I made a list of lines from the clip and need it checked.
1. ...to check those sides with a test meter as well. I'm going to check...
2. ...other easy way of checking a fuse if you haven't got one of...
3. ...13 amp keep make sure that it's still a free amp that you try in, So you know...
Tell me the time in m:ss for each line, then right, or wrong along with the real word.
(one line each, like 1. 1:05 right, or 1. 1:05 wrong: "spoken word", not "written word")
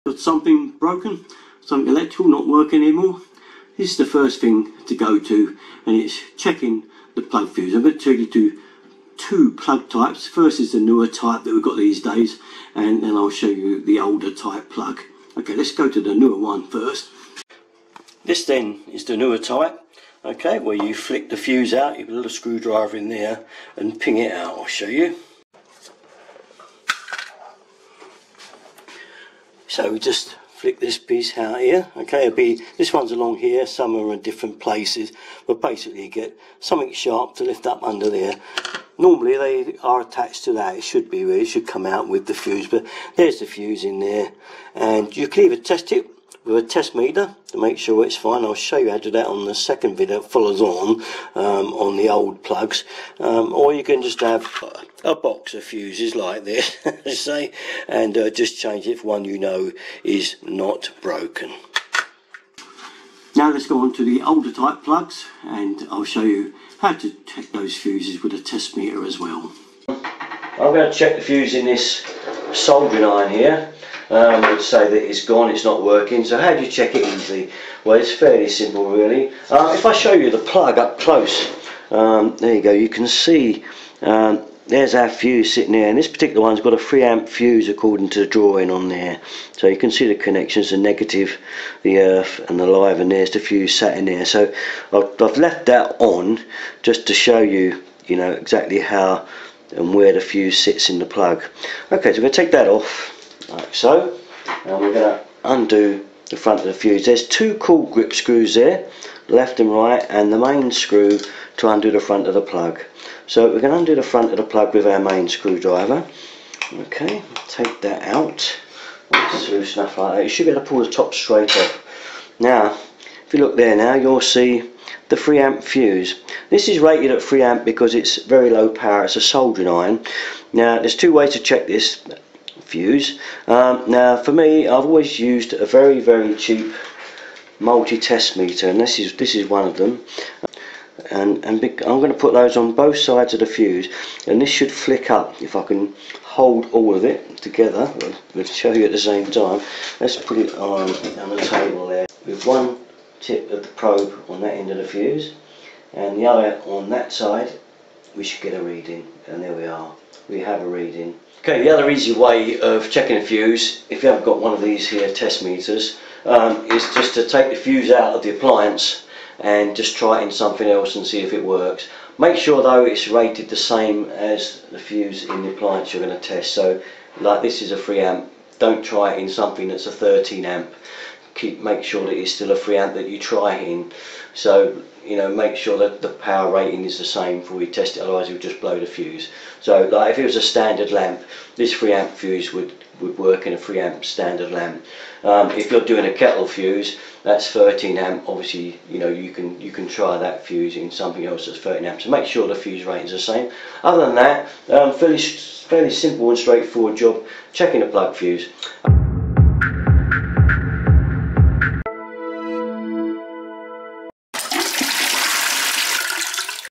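1. 1:06 wrong: "fuses", not "sides"
2. 2:41 right
3. 2:59 right.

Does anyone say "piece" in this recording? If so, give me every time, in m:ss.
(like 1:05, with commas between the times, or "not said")
0:30.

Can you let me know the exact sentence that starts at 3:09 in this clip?
So like if it was a standard lamp, this free amp fuse would, would work in a free amp standard lamp.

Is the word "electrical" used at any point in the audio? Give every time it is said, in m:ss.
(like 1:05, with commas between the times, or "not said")
0:01.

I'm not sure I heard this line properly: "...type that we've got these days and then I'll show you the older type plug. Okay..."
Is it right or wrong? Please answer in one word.
right.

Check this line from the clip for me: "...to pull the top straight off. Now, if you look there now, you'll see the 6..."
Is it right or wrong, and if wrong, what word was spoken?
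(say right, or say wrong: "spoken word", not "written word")
wrong: "3", not "6".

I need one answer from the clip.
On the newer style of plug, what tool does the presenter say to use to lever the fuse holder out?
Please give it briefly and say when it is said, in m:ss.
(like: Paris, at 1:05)
little screwdriver, at 0:22.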